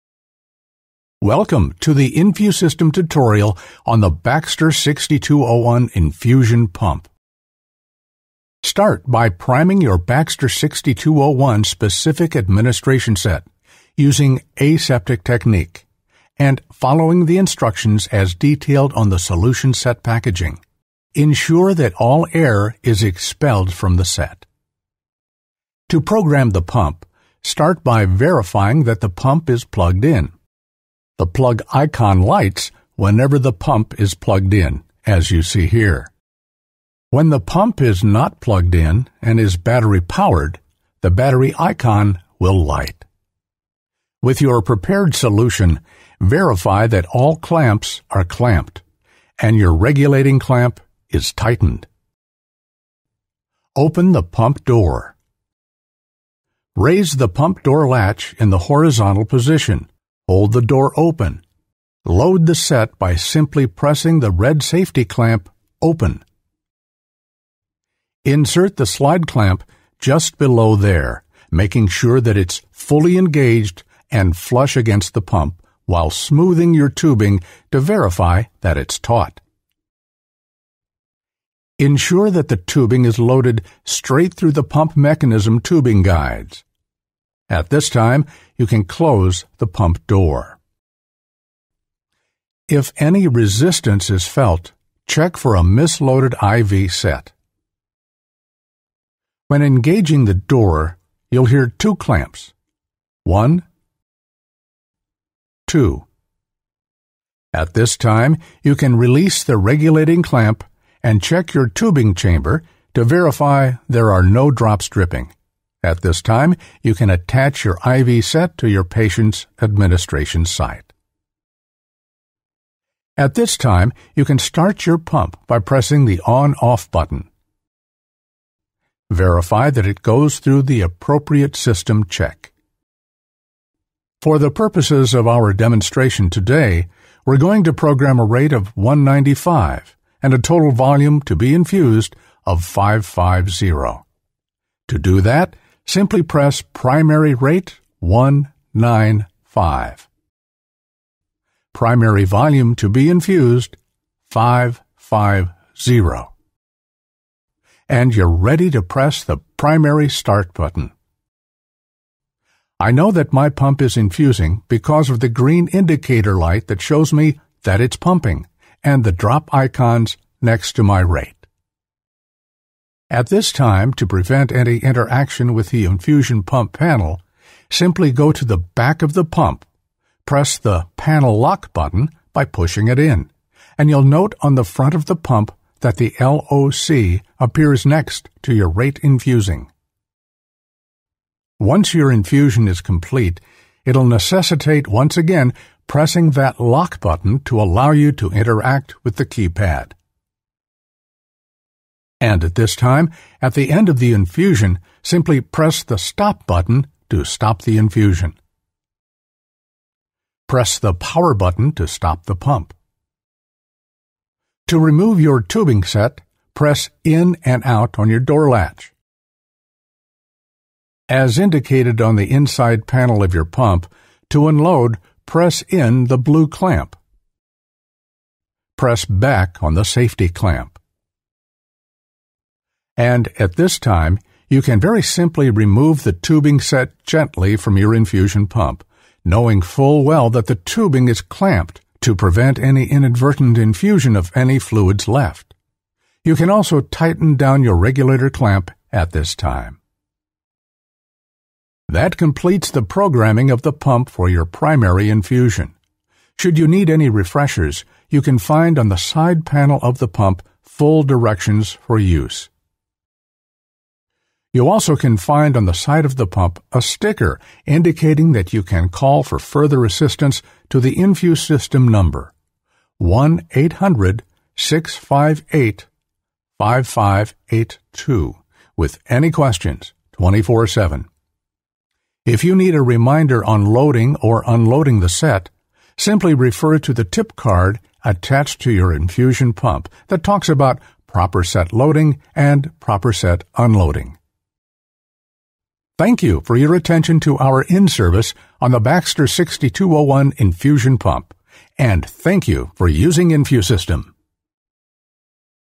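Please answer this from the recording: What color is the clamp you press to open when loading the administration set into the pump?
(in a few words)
red.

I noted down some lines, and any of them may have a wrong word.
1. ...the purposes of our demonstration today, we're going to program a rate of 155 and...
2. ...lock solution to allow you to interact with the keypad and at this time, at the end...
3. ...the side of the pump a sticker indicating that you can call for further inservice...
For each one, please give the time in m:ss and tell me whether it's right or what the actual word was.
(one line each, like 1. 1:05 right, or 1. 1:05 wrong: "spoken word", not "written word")
1. 2:14 wrong: "195", not "155"
2. 3:16 wrong: "button", not "solution"
3. 4:25 wrong: "assistance", not "inservice".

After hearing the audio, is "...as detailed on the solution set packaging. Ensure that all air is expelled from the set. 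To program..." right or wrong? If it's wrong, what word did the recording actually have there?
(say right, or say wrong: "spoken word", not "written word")
right.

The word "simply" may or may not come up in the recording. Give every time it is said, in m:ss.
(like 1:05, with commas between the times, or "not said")
1:03, 2:25, 2:57, 3:25, 3:55, 4:45.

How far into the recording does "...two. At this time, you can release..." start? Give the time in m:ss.
1:45.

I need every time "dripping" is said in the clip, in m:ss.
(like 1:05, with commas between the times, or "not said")
1:54.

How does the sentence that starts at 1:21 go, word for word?
Ensure that the tubing is loaded straight through the pump mechanism tubing guides.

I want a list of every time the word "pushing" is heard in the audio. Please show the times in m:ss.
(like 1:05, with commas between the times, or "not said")
3:02.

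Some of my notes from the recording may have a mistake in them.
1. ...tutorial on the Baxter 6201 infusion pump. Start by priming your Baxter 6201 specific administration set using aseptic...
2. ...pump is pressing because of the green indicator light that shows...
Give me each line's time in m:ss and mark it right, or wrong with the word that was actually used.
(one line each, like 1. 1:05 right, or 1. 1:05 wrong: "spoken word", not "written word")
1. 0:02 right
2. 2:43 wrong: "infusing", not "pressing".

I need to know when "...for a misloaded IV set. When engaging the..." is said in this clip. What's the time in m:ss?
1:35.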